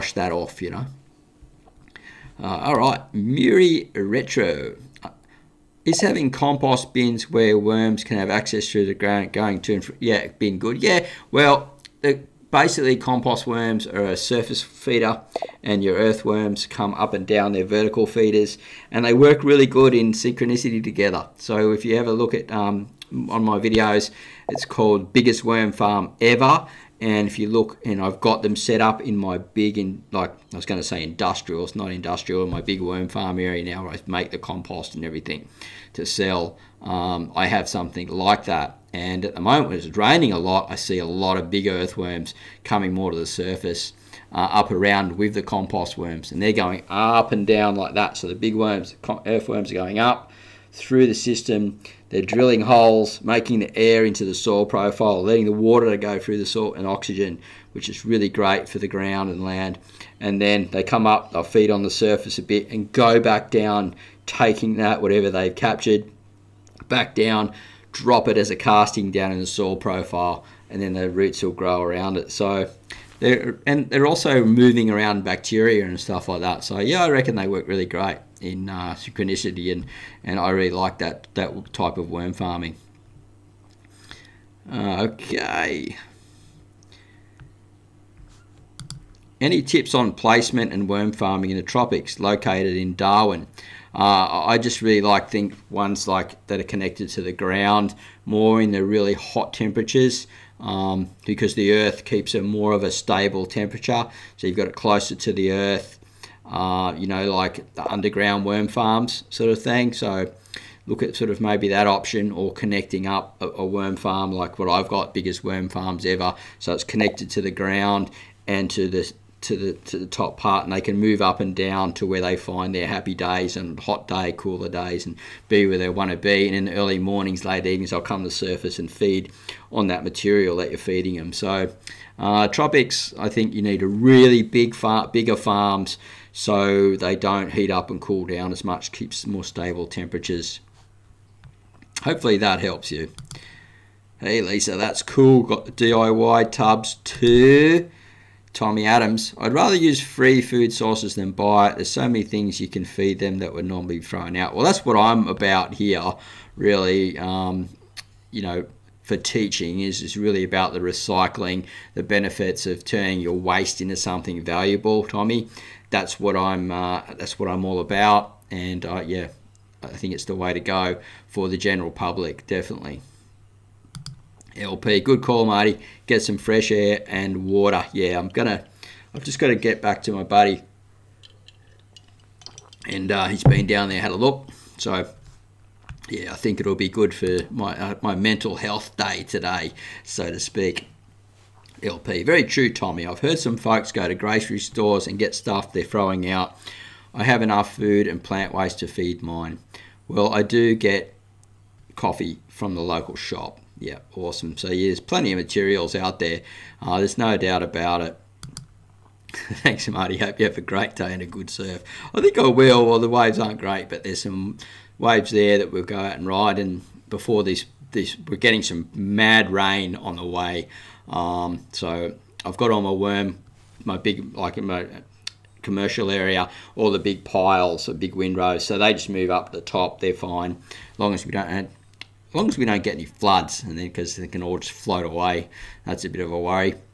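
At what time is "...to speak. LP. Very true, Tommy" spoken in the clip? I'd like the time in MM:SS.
03:10.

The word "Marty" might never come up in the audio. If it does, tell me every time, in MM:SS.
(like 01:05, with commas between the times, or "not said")
02:55, 03:29.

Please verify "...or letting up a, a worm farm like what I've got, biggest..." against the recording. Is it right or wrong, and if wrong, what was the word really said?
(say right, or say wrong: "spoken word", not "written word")
wrong: "connecting", not "letting".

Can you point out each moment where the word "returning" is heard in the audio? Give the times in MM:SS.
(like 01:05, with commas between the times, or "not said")
not said.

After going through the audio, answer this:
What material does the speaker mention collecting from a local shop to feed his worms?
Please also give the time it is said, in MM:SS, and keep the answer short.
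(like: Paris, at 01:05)
Coffee, at 03:21.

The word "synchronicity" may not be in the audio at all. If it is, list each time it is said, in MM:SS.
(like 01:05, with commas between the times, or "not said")
00:20, 01:18.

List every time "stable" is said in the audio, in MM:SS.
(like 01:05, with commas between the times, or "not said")
01:42, 02:19.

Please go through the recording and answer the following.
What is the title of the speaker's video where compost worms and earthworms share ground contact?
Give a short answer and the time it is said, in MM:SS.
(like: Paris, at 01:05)
Biggest worm farm ever, at 00:25.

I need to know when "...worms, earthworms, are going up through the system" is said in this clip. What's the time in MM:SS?
00:48.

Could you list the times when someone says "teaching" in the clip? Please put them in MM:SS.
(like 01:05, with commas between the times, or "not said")
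02:39.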